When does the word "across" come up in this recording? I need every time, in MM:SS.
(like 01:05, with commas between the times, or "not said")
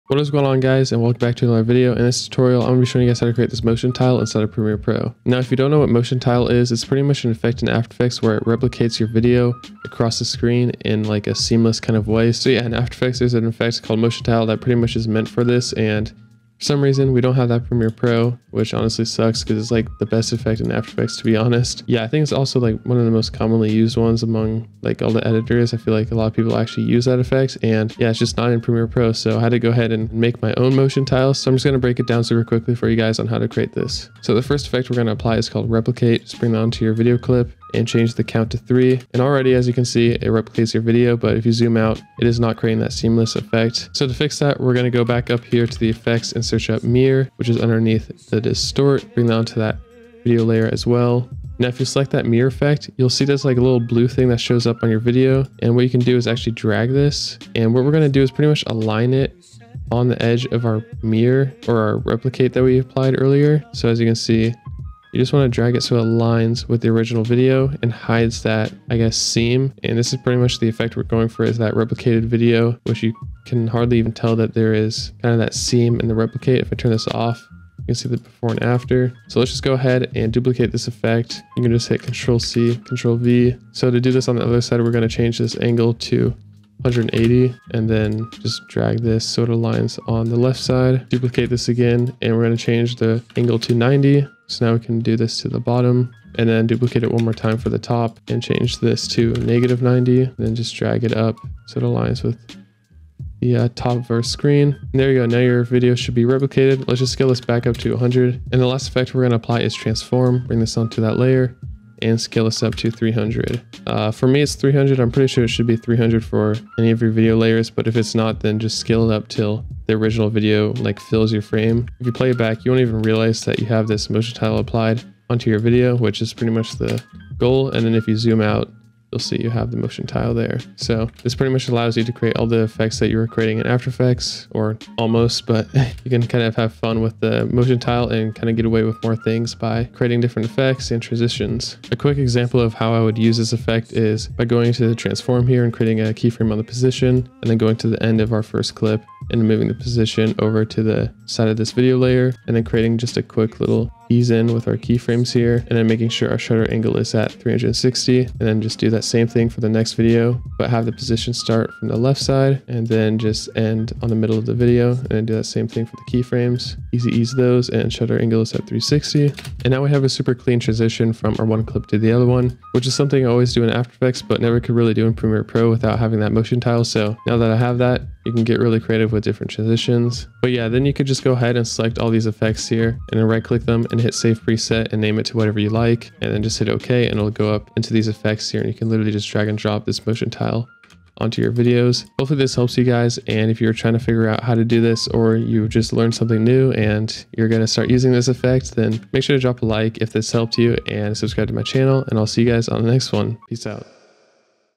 00:09.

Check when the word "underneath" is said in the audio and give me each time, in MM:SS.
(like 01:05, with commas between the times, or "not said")
00:47.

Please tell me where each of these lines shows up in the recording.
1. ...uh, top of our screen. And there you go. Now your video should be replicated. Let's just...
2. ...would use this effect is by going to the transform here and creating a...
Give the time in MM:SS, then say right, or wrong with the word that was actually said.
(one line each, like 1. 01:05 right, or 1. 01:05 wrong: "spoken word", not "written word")
1. 01:43 right
2. 02:23 right.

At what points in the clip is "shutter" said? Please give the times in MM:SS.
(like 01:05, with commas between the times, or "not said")
02:36, 02:47.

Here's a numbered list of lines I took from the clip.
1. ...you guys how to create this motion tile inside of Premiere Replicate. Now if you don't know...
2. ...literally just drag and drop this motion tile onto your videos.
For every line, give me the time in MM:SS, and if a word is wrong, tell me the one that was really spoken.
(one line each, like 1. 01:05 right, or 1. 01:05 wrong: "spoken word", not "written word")
1. 00:03 wrong: "Pro", not "Replicate"
2. 03:08 right.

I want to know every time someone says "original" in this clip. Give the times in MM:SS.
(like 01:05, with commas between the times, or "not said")
01:06, 01:59.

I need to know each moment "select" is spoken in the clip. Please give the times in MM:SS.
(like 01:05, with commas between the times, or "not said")
00:51, 03:01.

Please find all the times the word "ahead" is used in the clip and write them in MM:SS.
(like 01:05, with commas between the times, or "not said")
00:29, 01:19, 03:01.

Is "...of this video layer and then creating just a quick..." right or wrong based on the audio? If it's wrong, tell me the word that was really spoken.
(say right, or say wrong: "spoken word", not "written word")
right.